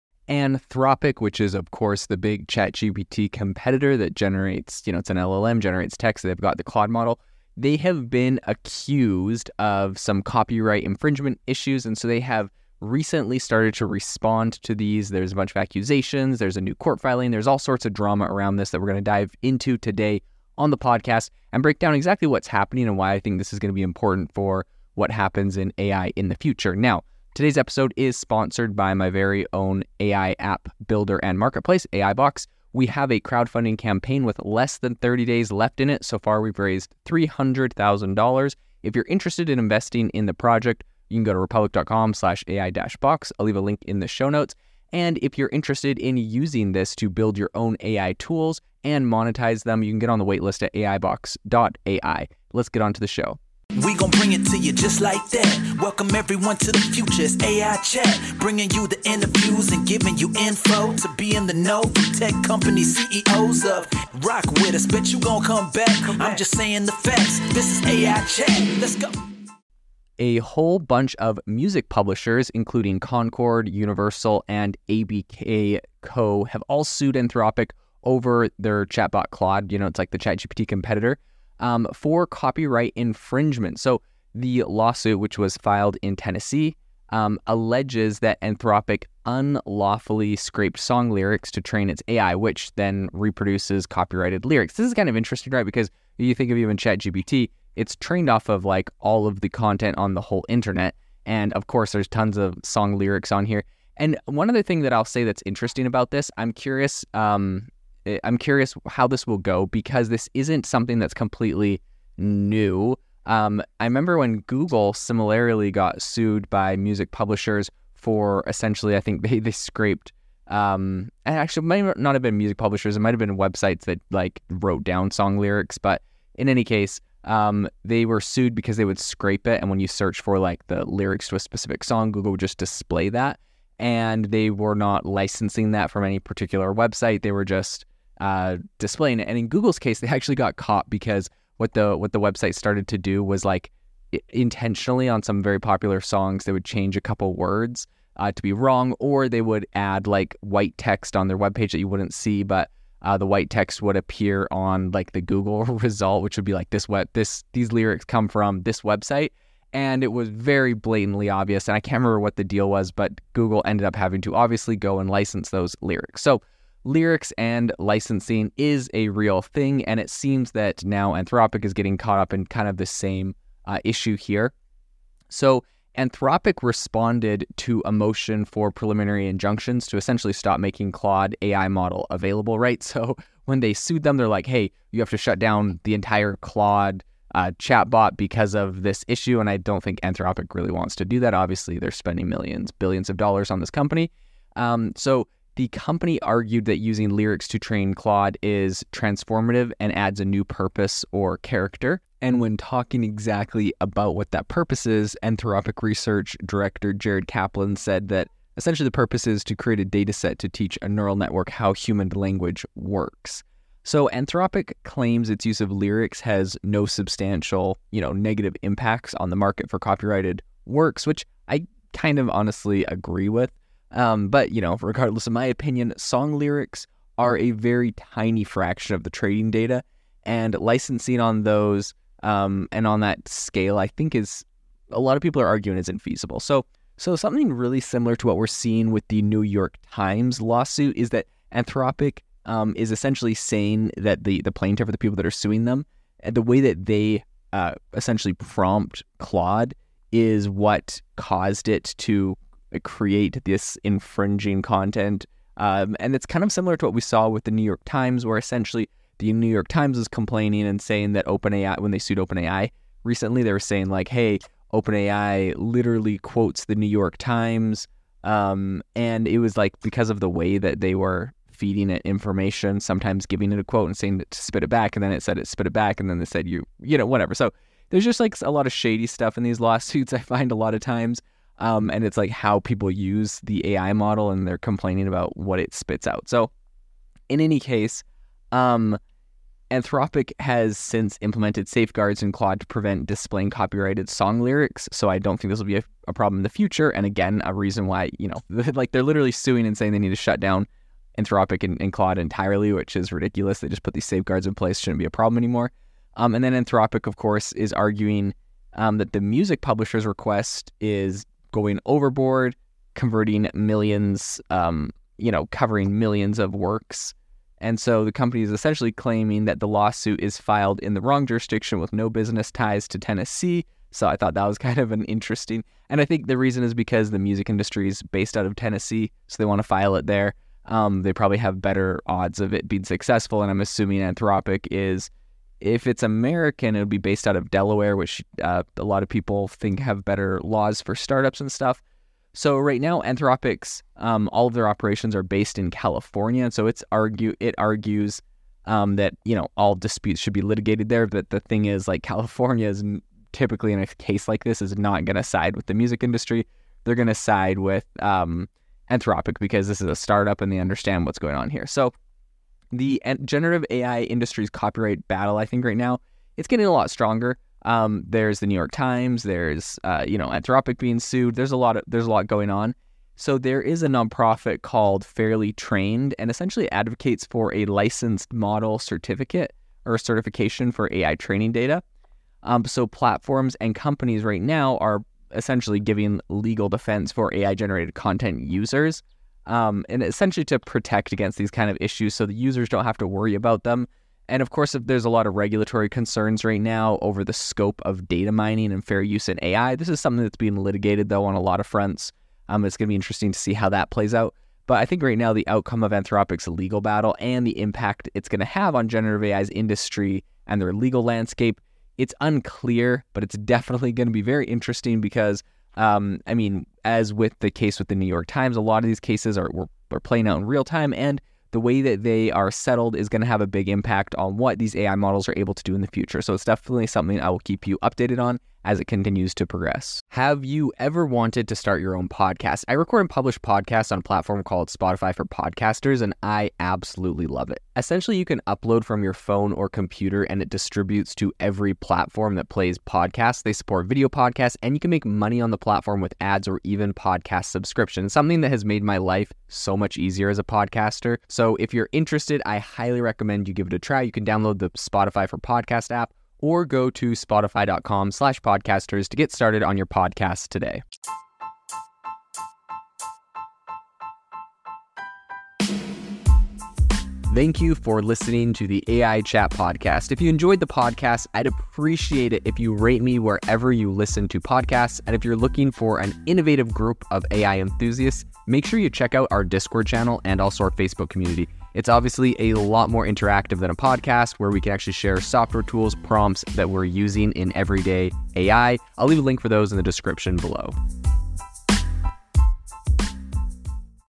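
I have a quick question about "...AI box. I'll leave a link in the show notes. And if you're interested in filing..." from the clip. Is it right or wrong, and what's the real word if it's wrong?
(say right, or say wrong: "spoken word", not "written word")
wrong: "using", not "filing".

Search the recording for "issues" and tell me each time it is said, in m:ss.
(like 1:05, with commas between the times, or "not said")
0:11, 2:53, 3:09, 6:31.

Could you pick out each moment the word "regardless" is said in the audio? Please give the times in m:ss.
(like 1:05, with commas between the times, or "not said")
3:44.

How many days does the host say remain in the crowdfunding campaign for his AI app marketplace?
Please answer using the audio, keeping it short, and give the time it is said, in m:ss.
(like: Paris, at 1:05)
Less than 30, at 0:34.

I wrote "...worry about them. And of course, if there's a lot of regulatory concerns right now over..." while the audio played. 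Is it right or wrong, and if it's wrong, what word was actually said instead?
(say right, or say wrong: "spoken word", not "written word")
right.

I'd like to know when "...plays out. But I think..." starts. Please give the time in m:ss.
6:43.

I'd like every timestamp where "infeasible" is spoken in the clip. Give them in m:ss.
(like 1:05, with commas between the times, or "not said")
3:55.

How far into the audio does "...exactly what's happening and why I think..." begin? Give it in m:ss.
0:21.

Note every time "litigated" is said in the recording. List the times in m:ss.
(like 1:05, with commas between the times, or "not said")
5:50, 6:40.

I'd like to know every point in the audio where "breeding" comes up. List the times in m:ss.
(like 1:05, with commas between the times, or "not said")
not said.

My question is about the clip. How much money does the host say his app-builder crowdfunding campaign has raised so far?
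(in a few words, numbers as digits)
$300,000.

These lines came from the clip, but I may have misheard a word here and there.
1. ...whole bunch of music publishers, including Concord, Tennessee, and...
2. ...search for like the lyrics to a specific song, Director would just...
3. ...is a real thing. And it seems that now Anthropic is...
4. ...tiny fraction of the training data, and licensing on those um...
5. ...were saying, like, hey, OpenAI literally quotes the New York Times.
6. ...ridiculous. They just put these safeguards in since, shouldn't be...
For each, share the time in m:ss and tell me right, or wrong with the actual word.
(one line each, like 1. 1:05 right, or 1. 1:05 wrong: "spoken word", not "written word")
1. 1:10 wrong: "Universal", not "Tennessee"
2. 2:09 wrong: "Google", not "Director"
3. 2:48 right
4. 3:47 right
5. 4:23 right
6. 5:03 wrong: "place", not "since".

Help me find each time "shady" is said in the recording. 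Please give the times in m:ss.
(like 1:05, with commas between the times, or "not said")
4:38.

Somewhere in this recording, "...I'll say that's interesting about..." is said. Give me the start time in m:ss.
1:44.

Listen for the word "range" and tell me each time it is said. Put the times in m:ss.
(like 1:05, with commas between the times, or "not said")
not said.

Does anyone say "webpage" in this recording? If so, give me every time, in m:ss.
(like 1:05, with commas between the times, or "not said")
2:31.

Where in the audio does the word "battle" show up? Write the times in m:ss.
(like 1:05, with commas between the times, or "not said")
6:05, 6:46.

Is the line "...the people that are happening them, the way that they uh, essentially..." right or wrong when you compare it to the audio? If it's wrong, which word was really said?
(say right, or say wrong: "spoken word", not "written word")
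wrong: "suing", not "happening".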